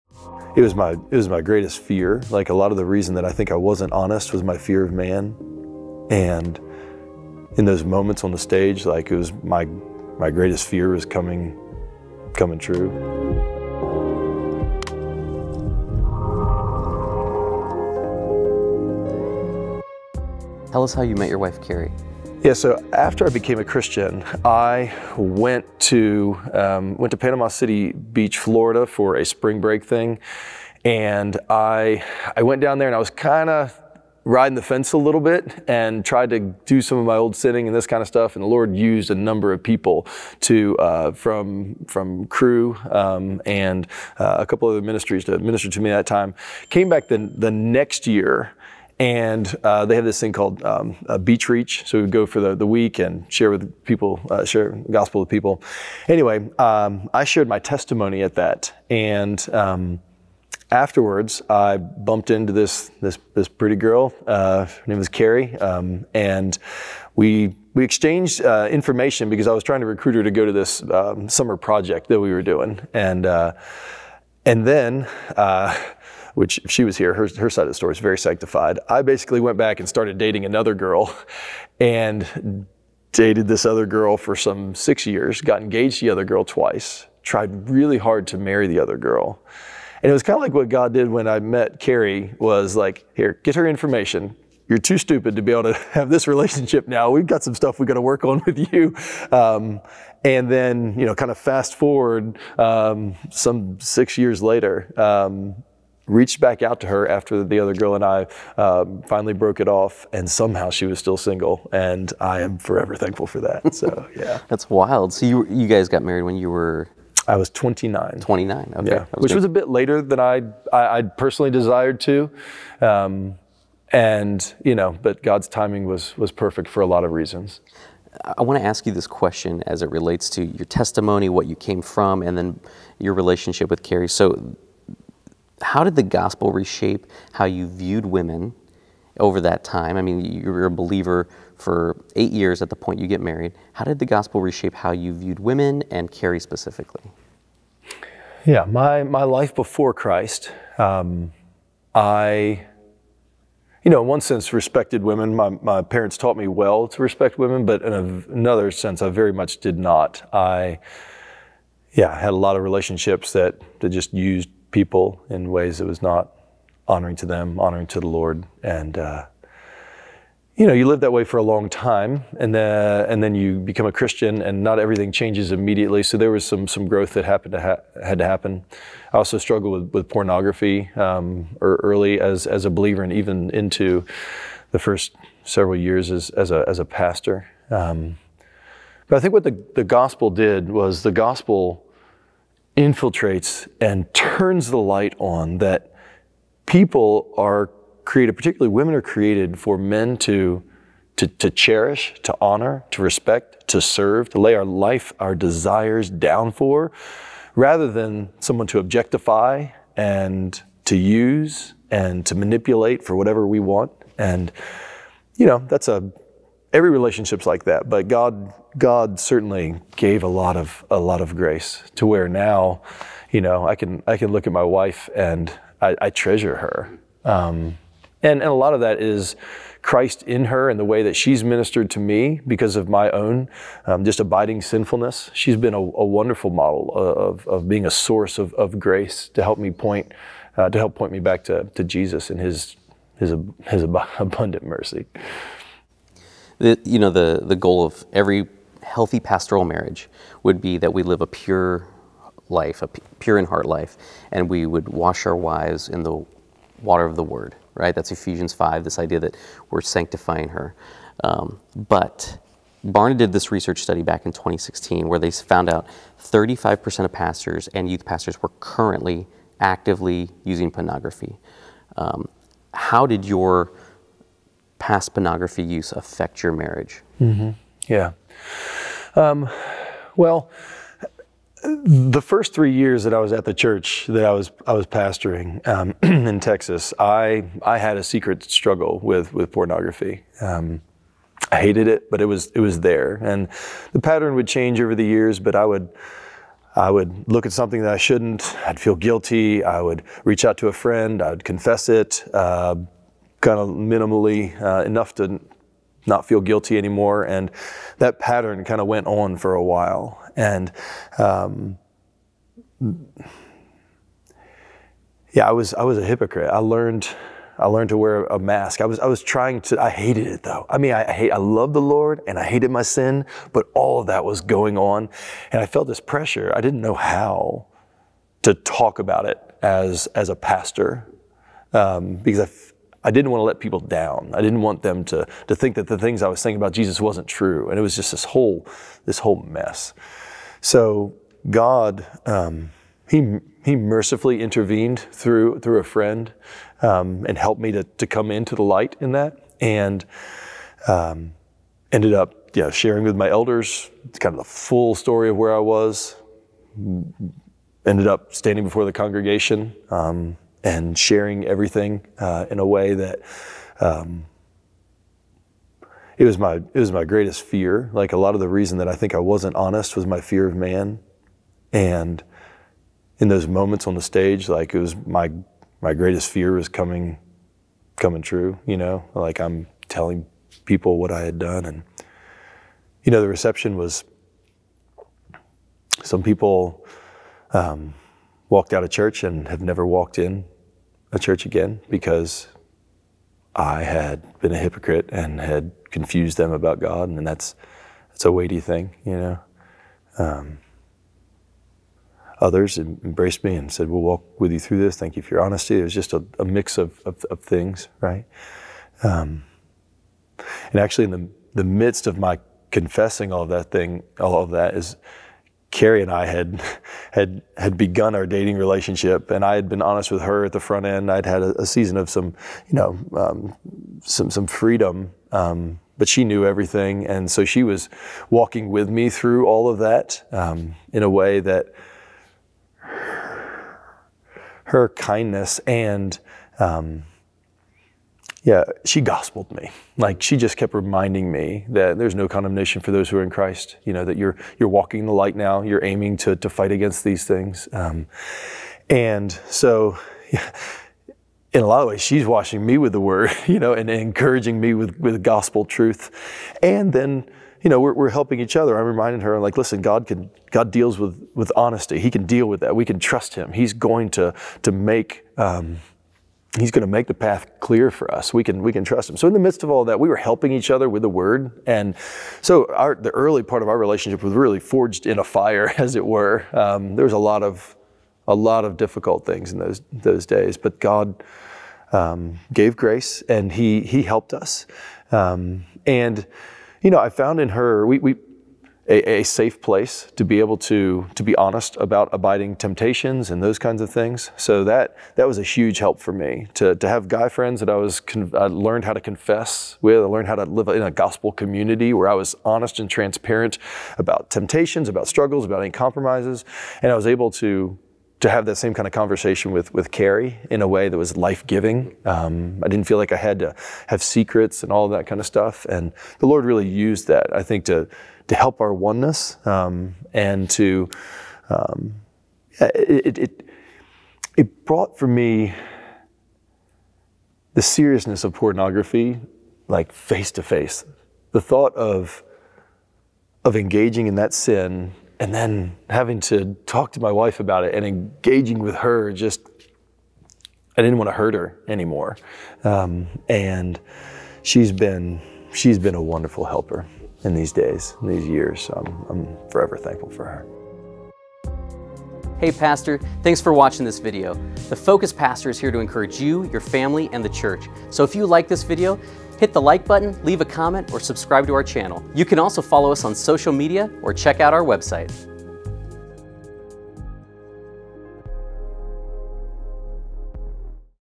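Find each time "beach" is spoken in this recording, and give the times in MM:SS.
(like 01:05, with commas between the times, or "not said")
00:27, 00:51.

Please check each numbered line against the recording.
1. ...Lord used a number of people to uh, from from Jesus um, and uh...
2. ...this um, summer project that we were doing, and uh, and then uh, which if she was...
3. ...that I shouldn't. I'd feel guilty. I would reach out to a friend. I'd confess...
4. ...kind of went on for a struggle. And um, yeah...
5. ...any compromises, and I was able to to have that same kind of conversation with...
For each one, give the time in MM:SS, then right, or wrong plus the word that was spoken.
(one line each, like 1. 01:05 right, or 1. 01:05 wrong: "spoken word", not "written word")
1. 00:38 wrong: "Cru", not "Jesus"
2. 01:10 right
3. 04:57 right
4. 05:08 wrong: "while", not "struggle"
5. 08:25 right.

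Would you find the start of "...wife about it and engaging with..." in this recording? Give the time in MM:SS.
08:57.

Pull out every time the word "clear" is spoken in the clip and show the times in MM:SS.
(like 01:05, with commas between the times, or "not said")
07:47.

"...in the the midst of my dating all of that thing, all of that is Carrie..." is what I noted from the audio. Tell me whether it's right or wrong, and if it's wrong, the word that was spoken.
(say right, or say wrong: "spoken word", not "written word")
wrong: "confessing", not "dating".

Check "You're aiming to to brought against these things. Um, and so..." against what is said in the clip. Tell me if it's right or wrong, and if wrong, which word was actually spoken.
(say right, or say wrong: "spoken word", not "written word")
wrong: "fight", not "brought".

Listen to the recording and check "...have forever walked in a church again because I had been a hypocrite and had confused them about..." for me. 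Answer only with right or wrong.
wrong.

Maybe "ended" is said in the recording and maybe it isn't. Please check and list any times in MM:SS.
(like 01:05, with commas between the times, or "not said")
05:51, 05:57.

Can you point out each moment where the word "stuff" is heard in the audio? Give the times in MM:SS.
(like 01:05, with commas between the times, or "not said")
00:38, 01:37, 08:35.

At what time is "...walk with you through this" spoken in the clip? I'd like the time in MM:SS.
06:44.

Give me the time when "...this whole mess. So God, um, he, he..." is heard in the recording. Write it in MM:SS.
05:39.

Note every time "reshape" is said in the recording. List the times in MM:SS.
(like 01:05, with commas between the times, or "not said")
02:16, 02:24.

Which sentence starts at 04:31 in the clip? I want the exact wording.
Um, how did your past pornography use affect your marriage?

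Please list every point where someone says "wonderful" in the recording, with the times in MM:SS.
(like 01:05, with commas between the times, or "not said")
03:56, 09:06.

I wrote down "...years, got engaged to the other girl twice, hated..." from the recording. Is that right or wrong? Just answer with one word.
wrong.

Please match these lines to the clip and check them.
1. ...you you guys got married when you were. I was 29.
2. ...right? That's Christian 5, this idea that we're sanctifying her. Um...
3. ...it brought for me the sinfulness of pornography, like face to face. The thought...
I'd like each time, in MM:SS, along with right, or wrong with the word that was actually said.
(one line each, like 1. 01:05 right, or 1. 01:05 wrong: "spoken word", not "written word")
1. 01:55 right
2. 04:17 wrong: "Ephesians", not "Christian"
3. 08:44 wrong: "seriousness", not "sinfulness".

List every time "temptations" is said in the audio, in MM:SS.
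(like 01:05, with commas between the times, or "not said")
08:12, 08:24.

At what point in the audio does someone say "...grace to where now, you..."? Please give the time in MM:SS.
03:41.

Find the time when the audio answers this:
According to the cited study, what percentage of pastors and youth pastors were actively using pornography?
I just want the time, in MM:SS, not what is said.
04:26.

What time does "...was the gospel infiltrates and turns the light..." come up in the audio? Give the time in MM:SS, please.
03:10.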